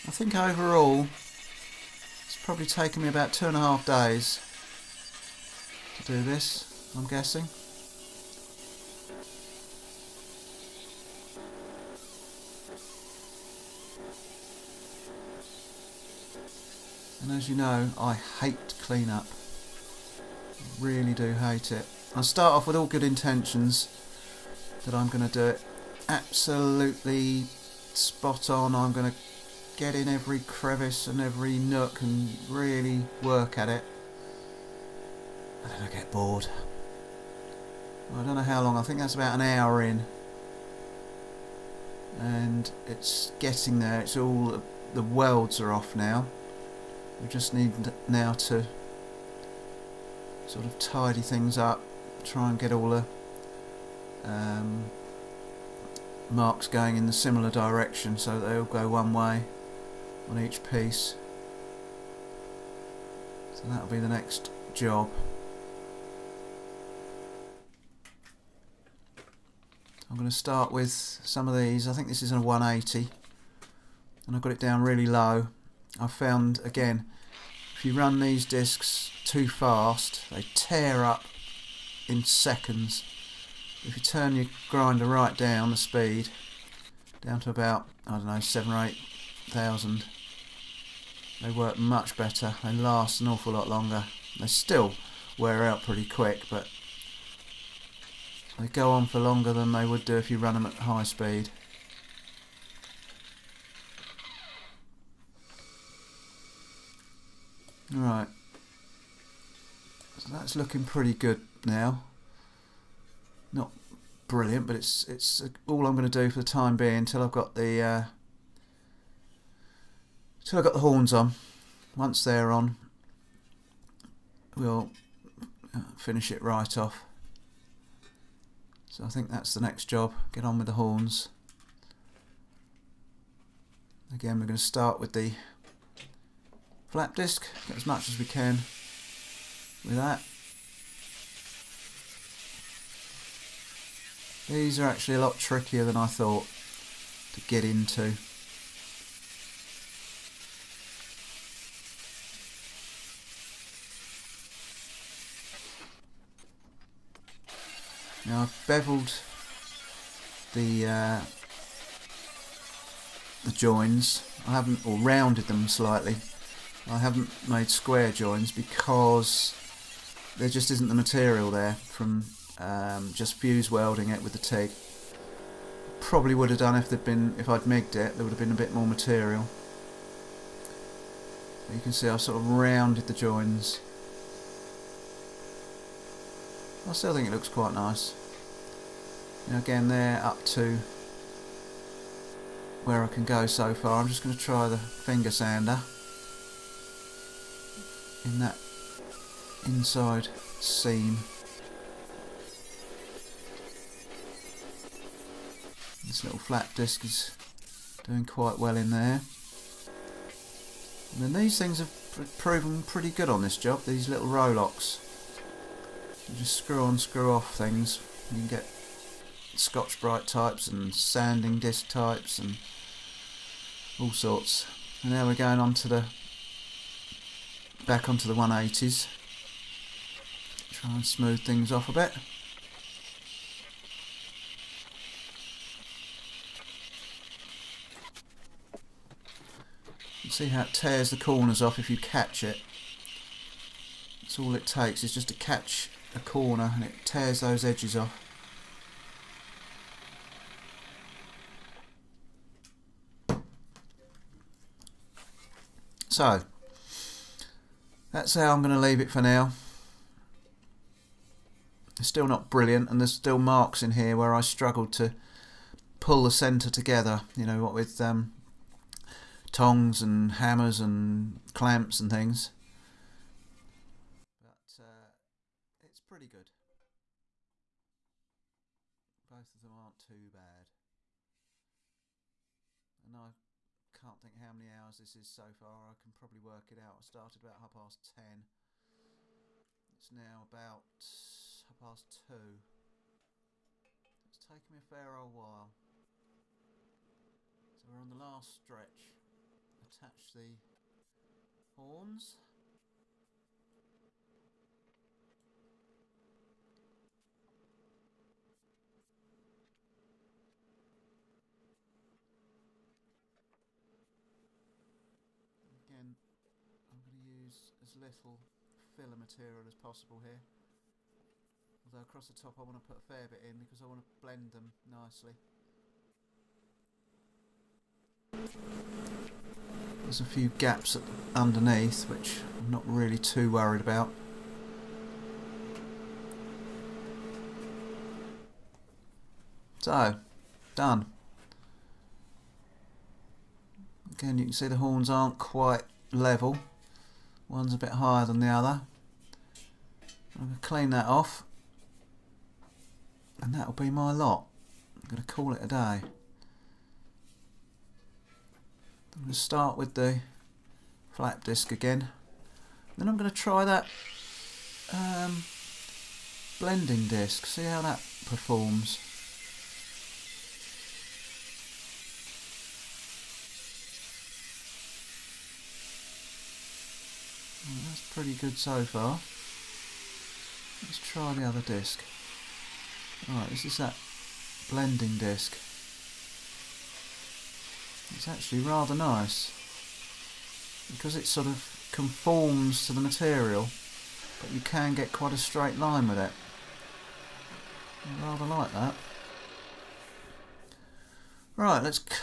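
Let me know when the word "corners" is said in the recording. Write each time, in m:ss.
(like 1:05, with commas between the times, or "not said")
4:01, 4:06.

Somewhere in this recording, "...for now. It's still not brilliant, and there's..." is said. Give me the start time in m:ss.
4:19.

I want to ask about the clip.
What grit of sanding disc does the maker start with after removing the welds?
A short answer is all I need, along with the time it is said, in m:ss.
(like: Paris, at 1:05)
180, at 1:12.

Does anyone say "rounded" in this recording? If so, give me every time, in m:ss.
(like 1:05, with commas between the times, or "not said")
2:44, 3:02.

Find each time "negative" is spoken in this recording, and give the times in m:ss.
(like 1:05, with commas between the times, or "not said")
not said.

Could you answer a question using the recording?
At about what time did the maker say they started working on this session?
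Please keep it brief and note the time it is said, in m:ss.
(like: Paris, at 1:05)
10:30, at 4:47.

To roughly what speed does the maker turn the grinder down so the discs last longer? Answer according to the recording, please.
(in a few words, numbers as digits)
7000 or 8000.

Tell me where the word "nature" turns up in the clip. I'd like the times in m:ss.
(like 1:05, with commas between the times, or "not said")
not said.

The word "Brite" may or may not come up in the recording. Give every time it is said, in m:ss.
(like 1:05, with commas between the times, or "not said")
3:40.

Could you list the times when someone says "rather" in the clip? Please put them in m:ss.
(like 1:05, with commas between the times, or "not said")
6:28, 6:38.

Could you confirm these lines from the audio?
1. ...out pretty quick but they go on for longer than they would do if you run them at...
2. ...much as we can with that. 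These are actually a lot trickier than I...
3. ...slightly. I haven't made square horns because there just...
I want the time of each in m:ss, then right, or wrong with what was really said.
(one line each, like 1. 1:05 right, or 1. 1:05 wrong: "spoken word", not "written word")
1. 1:35 right
2. 2:17 right
3. 2:45 wrong: "joins", not "horns".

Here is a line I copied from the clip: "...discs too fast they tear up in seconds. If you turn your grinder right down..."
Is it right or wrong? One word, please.
right.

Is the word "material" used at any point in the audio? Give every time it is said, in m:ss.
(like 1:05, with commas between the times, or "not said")
2:50, 2:58, 5:19, 6:33.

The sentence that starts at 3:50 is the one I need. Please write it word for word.
Try and smooth things off a bit.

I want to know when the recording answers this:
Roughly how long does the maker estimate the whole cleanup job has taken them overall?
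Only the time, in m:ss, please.
0:03.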